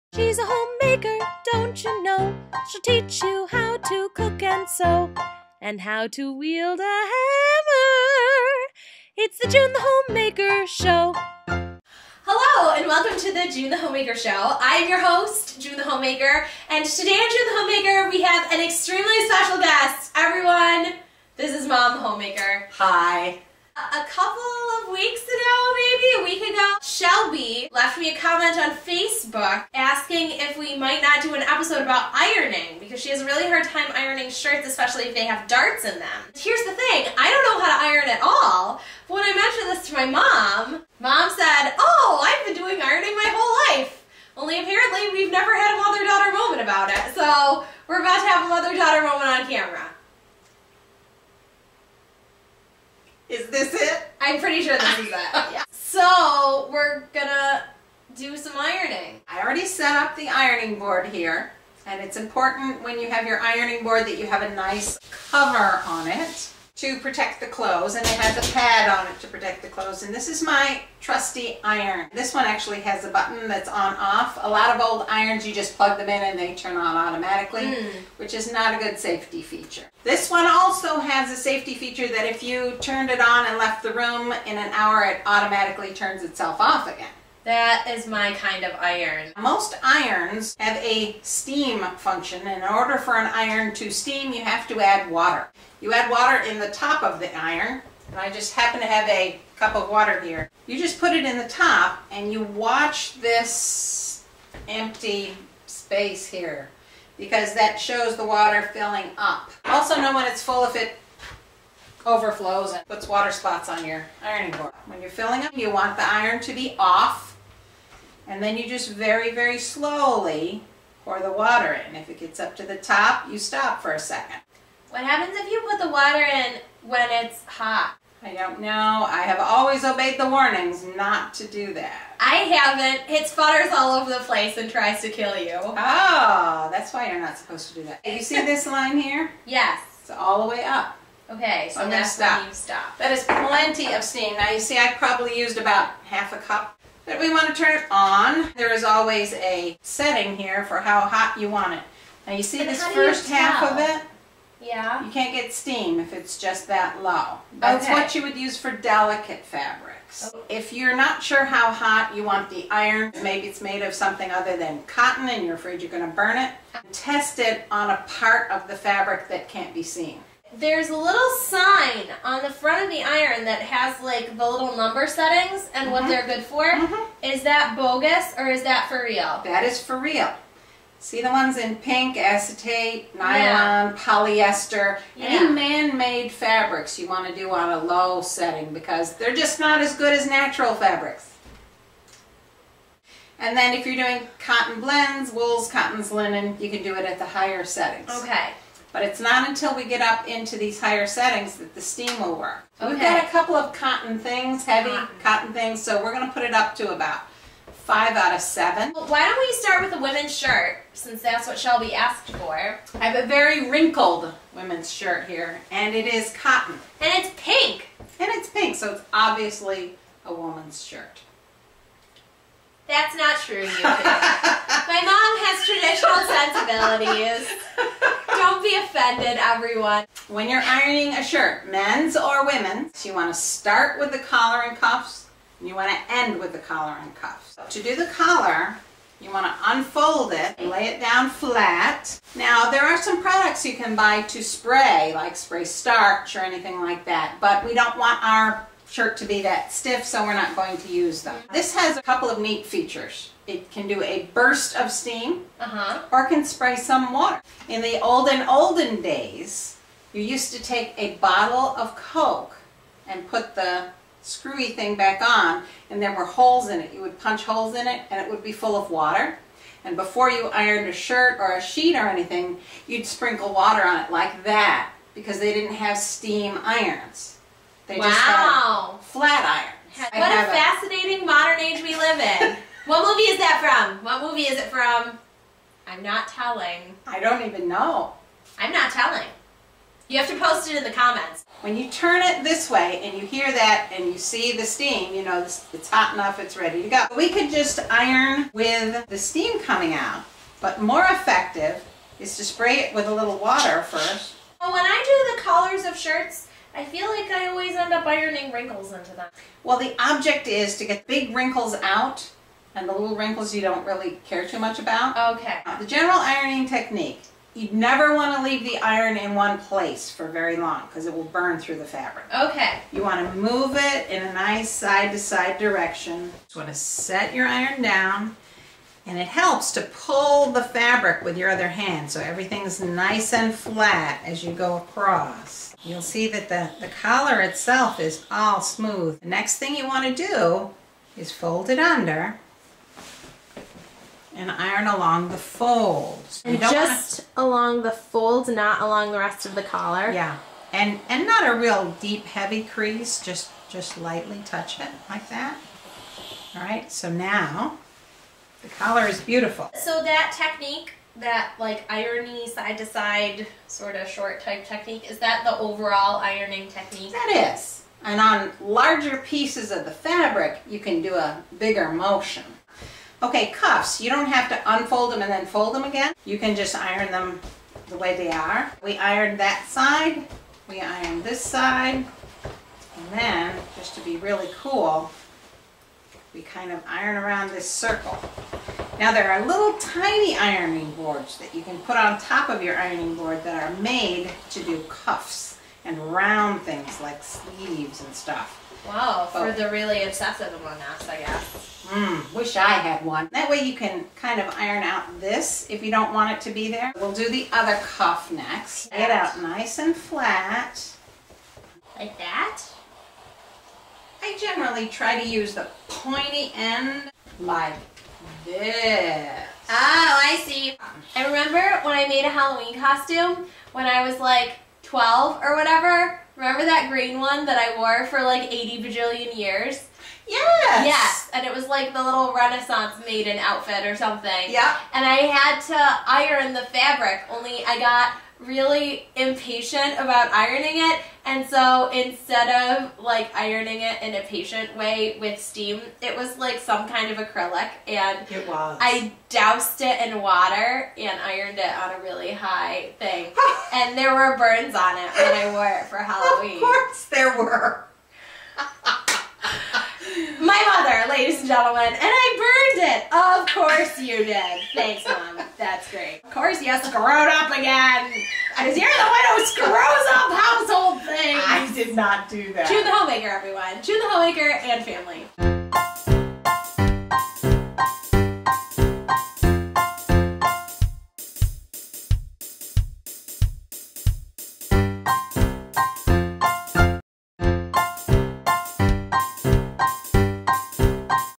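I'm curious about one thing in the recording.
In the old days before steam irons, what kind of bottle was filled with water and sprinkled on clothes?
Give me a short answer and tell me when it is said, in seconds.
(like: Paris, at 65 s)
a bottle of Coke, at 261 s.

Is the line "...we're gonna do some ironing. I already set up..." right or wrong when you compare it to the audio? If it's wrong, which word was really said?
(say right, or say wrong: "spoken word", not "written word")
right.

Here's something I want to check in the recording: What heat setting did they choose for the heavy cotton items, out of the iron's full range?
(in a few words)
5 out of 7.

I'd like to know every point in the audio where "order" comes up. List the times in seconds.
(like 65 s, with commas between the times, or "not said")
92 s.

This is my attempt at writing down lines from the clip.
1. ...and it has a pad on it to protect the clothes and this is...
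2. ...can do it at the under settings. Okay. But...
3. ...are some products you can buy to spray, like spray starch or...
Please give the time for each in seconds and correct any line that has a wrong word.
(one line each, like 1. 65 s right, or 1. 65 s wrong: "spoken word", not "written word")
1. 67 s right
2. 196 s wrong: "higher", not "under"
3. 242 s right.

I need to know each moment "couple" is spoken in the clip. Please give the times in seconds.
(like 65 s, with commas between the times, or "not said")
24 s, 203 s, 252 s.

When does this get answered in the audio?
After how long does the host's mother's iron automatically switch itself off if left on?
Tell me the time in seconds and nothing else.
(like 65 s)
84 s.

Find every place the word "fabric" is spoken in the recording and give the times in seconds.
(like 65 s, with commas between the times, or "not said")
159 s, 168 s, 186 s, 190 s, 321 s, 330 s, 369 s, 436 s.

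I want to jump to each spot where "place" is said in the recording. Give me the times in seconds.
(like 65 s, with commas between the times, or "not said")
134 s, 319 s.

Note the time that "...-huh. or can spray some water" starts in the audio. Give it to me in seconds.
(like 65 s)
255 s.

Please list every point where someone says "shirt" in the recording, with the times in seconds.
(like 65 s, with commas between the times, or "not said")
34 s, 210 s, 214 s, 220 s, 231 s, 248 s, 271 s, 305 s.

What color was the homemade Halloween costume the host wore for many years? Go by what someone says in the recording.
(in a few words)
green.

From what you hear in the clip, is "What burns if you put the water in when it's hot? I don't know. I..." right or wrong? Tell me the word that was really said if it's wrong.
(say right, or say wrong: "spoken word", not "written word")
wrong: "happens", not "burns".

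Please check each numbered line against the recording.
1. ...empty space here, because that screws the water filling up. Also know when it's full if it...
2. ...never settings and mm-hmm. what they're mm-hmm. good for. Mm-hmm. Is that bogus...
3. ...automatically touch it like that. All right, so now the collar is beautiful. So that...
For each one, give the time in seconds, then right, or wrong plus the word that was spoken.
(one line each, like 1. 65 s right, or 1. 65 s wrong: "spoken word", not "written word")
1. 104 s wrong: "shows", not "screws"
2. 174 s wrong: "number", not "never"
3. 353 s wrong: "lightly", not "automatically".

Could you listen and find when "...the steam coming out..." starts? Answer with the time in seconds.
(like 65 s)
299 s.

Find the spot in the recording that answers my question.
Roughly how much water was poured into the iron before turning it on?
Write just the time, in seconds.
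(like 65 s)
146 s.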